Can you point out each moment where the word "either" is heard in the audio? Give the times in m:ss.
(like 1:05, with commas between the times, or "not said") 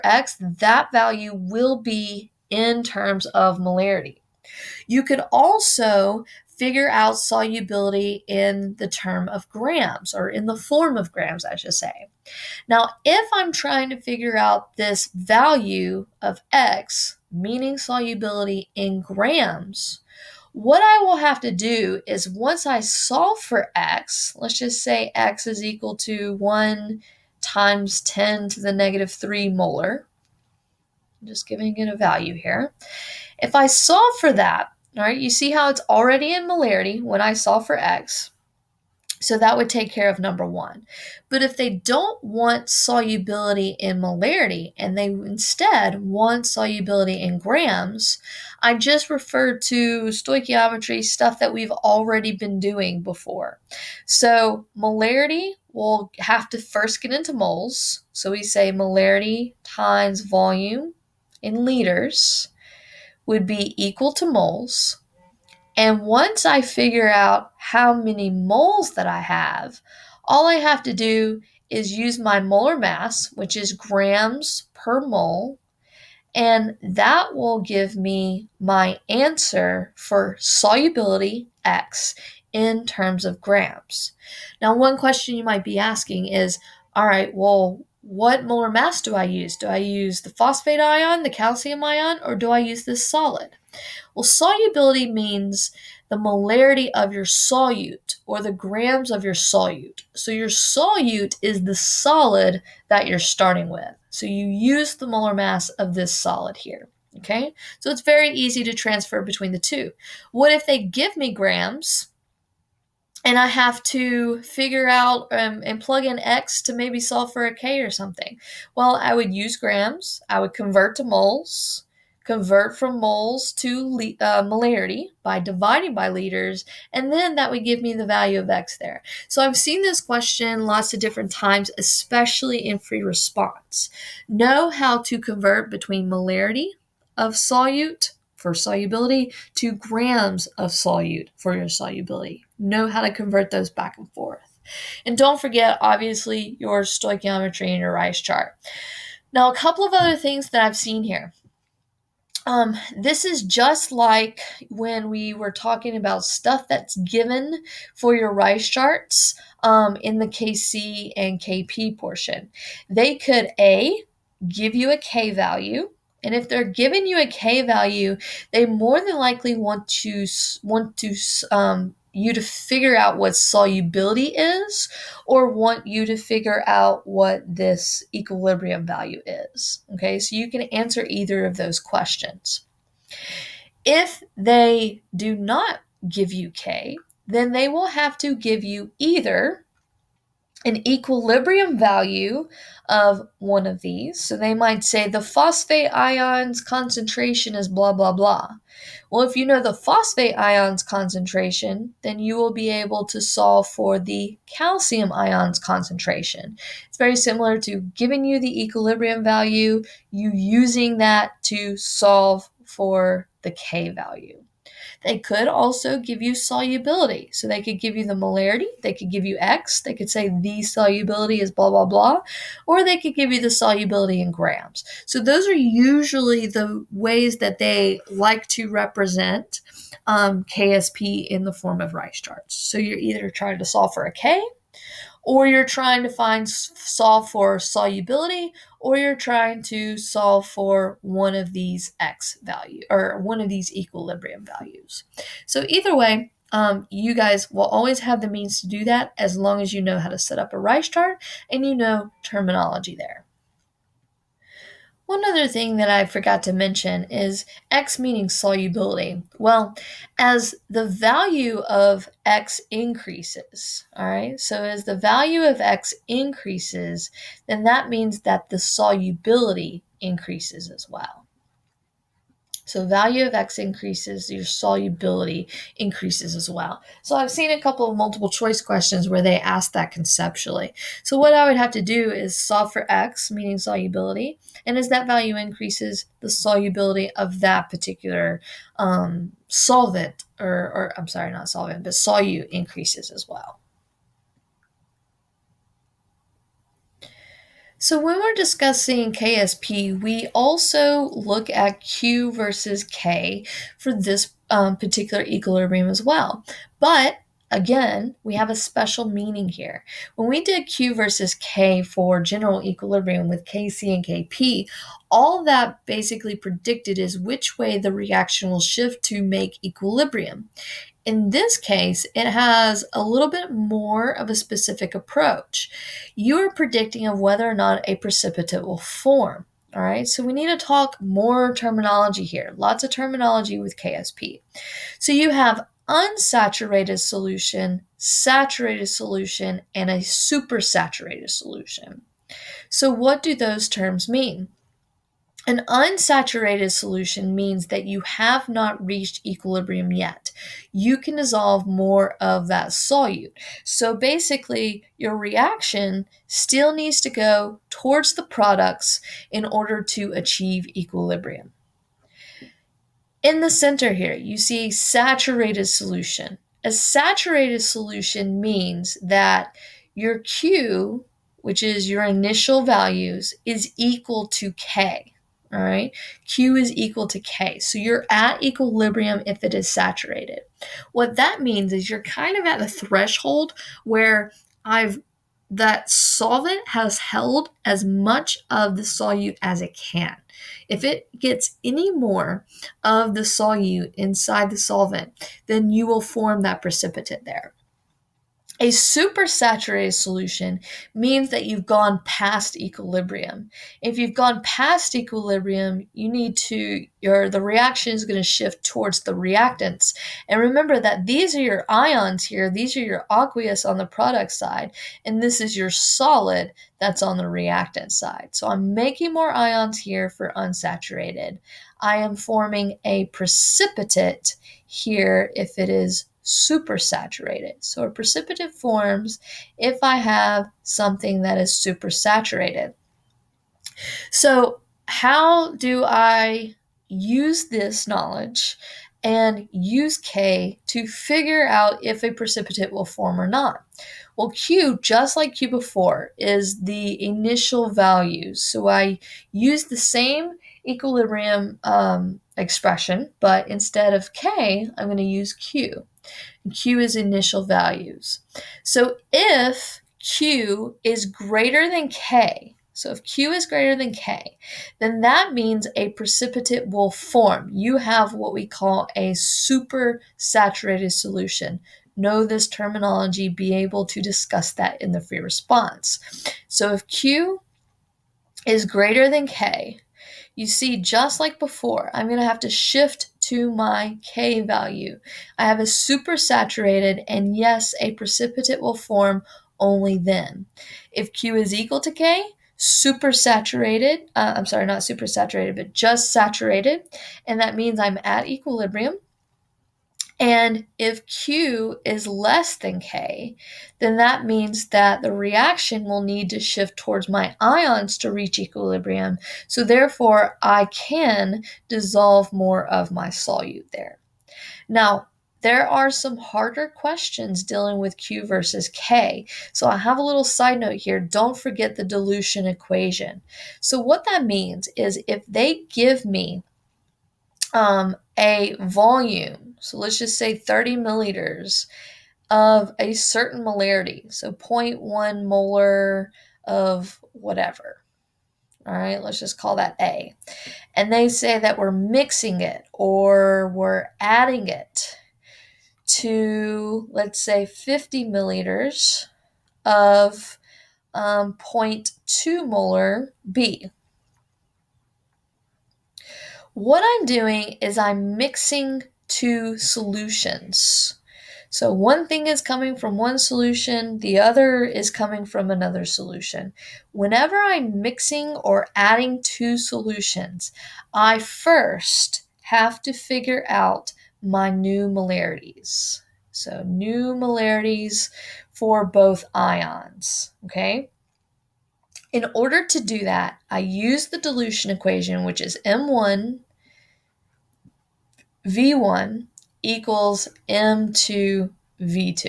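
3:01, 3:08, 3:52, 4:05.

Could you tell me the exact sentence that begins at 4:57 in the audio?
So when we're discussing KSP, we also look at Q versus K for this um, particular equilibrium as well.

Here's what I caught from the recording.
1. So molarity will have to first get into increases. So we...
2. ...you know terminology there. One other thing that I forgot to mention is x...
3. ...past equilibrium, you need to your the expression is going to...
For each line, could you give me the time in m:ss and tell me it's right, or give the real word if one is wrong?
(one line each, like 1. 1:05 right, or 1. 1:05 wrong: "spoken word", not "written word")
1. 0:54 wrong: "moles", not "increases"
2. 4:11 right
3. 6:44 wrong: "reaction", not "expression".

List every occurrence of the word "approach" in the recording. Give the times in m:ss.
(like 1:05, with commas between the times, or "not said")
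5:24.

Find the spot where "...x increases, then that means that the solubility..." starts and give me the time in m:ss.
4:25.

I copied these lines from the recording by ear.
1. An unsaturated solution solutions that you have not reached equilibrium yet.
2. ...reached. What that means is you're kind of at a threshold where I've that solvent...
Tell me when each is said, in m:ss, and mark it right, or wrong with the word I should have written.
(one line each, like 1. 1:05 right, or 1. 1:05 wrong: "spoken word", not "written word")
1. 5:45 wrong: "means", not "solutions"
2. 6:19 wrong: "saturated", not "reached".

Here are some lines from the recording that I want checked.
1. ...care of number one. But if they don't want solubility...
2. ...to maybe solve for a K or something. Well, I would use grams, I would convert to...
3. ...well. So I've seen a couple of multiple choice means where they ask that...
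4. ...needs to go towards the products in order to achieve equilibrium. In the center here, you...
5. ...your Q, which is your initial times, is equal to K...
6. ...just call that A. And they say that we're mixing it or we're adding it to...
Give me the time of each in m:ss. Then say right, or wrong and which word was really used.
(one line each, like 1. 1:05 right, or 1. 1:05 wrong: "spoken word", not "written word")
1. 0:39 right
2. 1:56 right
3. 4:36 wrong: "questions", not "means"
4. 5:56 right
5. 6:09 wrong: "values", not "times"
6. 8:59 right.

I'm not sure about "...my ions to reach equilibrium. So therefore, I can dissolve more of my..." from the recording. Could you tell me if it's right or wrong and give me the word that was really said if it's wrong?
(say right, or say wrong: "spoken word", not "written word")
right.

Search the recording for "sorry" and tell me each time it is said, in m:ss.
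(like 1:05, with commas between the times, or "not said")
4:51, 8:14.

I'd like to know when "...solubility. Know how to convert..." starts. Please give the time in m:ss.
2:21.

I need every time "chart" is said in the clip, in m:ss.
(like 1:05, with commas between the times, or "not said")
2:28, 2:38, 3:52, 4:10.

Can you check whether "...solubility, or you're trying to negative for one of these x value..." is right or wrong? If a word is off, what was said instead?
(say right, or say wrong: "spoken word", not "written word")
wrong: "solve", not "negative".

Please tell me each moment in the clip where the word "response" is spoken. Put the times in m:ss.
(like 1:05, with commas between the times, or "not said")
2:13, 7:55.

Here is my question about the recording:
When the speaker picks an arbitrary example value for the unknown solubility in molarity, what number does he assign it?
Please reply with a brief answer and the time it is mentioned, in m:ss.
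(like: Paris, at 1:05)
1 × 10^-3 M, at 0:26.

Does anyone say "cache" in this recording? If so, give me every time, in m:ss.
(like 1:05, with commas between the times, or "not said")
not said.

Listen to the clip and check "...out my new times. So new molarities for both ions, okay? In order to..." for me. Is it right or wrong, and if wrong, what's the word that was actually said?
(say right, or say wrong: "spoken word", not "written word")
wrong: "molarities", not "times".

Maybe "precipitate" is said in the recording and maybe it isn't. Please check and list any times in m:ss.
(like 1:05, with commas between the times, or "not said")
5:27, 6:36, 7:03, 7:07, 7:22, 7:45, 8:07.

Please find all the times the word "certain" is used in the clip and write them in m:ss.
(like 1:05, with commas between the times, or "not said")
8:52.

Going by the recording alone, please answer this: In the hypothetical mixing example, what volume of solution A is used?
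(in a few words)
30 milliliters.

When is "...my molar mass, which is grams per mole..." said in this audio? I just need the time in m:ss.
1:12.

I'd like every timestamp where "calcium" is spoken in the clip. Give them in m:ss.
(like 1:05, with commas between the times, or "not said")
1:31, 3:24.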